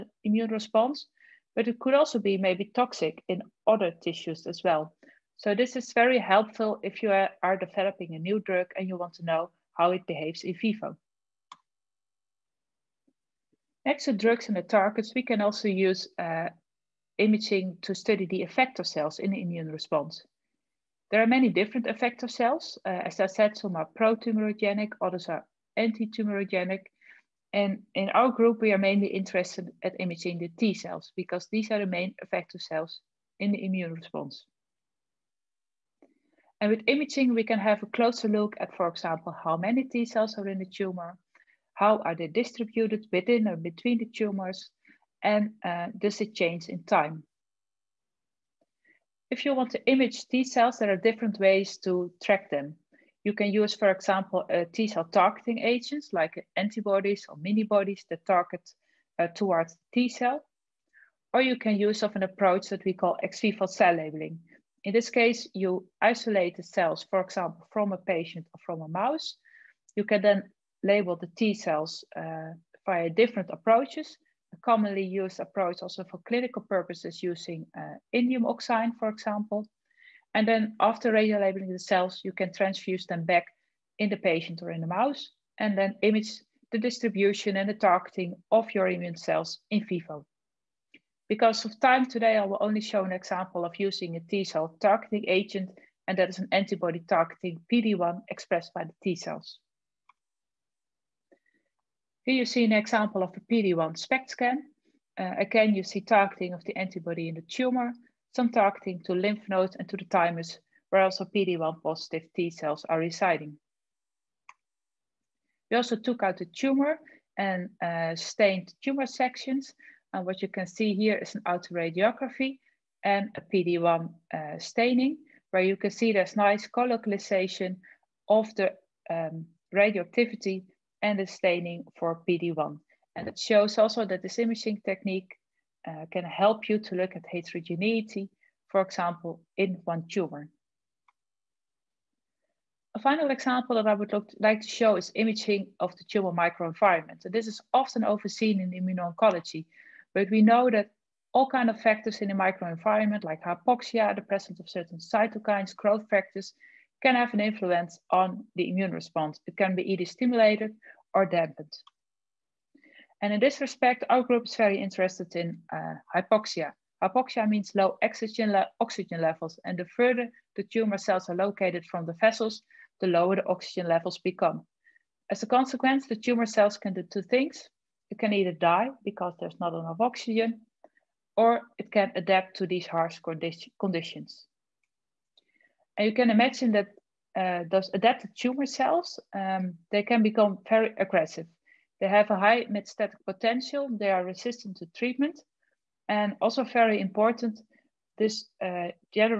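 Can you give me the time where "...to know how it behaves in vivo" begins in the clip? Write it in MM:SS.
00:09.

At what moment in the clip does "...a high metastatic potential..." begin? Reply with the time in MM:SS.
03:12.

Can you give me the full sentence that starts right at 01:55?
We also took out the tumor and uh, stained tumor sections.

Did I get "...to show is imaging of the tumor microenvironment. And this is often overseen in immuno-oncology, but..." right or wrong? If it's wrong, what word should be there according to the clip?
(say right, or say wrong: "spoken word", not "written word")
right.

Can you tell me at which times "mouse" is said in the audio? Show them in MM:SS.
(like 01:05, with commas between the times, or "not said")
01:08, 01:24.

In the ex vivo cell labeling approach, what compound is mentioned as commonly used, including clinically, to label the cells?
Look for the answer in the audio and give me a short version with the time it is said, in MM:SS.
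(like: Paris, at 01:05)
indium oxide, at 01:18.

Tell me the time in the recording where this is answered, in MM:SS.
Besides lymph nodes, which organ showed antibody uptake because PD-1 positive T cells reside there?
01:50.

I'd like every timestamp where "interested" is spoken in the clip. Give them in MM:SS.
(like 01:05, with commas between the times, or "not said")
00:29, 02:44.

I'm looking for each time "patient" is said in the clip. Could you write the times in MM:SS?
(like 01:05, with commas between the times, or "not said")
01:07, 01:24.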